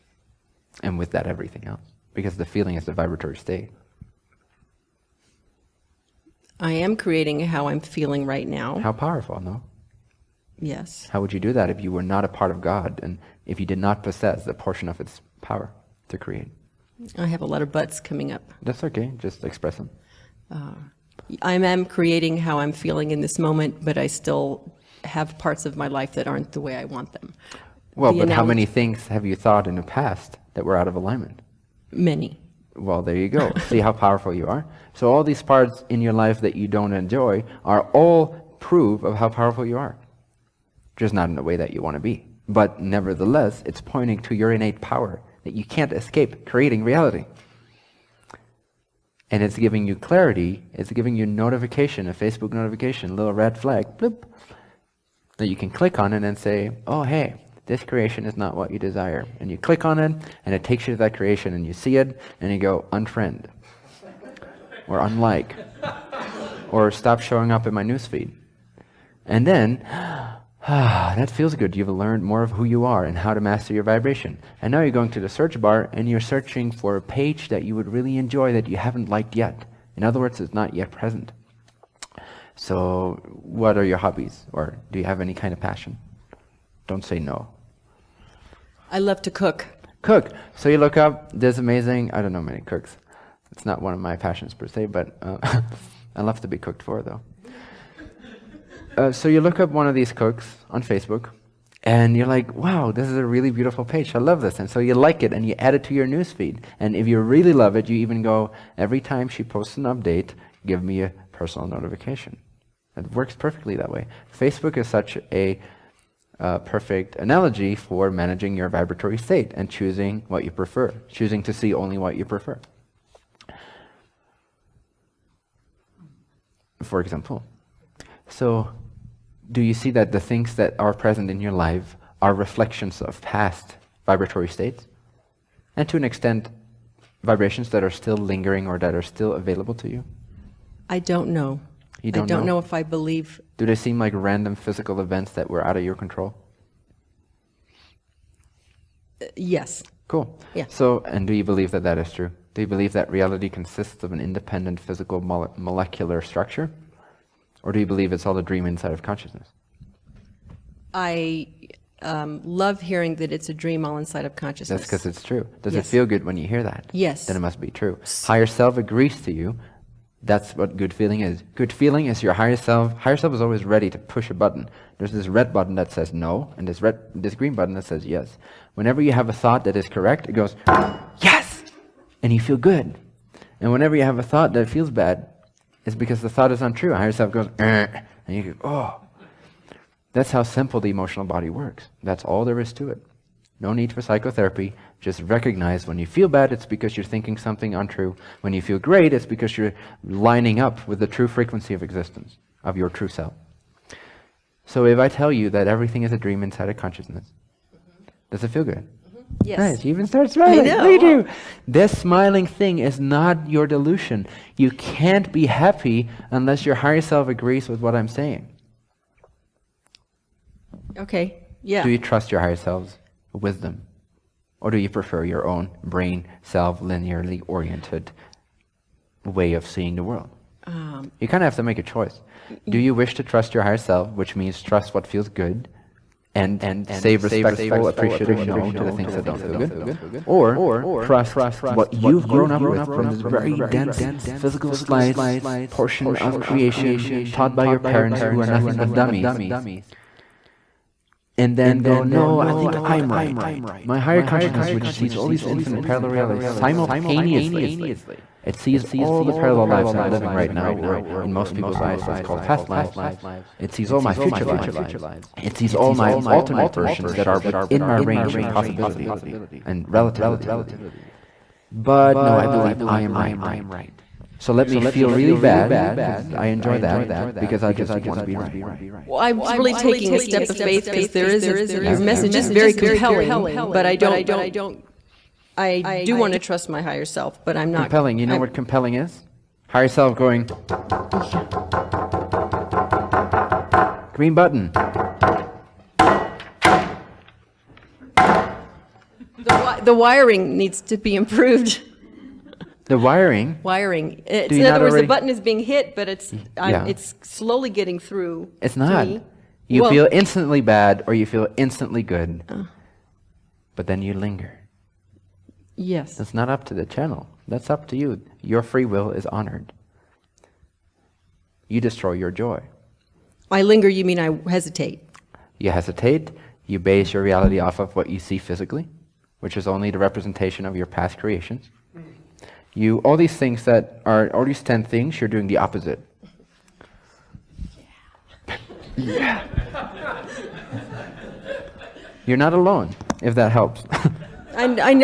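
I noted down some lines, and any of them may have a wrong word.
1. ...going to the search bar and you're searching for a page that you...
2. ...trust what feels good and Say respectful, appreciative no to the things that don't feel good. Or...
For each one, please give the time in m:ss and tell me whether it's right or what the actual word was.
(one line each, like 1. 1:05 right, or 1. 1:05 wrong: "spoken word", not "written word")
1. 1:14 right
2. 3:54 right.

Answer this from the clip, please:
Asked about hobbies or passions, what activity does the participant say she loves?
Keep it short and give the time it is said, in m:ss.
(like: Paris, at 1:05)
Cook, at 1:28.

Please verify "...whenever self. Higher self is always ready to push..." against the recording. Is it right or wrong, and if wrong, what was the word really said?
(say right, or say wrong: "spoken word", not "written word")
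wrong: "higher", not "whenever".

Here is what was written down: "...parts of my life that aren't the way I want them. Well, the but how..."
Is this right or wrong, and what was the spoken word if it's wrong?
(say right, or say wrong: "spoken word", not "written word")
right.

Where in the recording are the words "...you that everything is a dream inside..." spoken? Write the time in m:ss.
3:25.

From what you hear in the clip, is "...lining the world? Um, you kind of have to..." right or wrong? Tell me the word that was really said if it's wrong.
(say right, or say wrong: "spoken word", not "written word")
wrong: "seeing", not "lining".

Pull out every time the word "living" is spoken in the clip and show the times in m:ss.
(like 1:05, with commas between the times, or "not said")
4:20.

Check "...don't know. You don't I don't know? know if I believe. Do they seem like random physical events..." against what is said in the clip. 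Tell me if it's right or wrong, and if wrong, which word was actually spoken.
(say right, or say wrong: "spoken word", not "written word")
right.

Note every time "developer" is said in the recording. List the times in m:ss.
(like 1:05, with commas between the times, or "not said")
not said.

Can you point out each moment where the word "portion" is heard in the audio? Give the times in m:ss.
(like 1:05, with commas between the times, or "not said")
0:14, 4:05.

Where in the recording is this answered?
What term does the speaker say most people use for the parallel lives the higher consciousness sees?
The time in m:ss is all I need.
4:22.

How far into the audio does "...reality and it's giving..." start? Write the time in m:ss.
0:46.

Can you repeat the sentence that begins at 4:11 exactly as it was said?
And then go, no, I think I'm right.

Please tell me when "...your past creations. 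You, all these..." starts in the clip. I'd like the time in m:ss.
5:30.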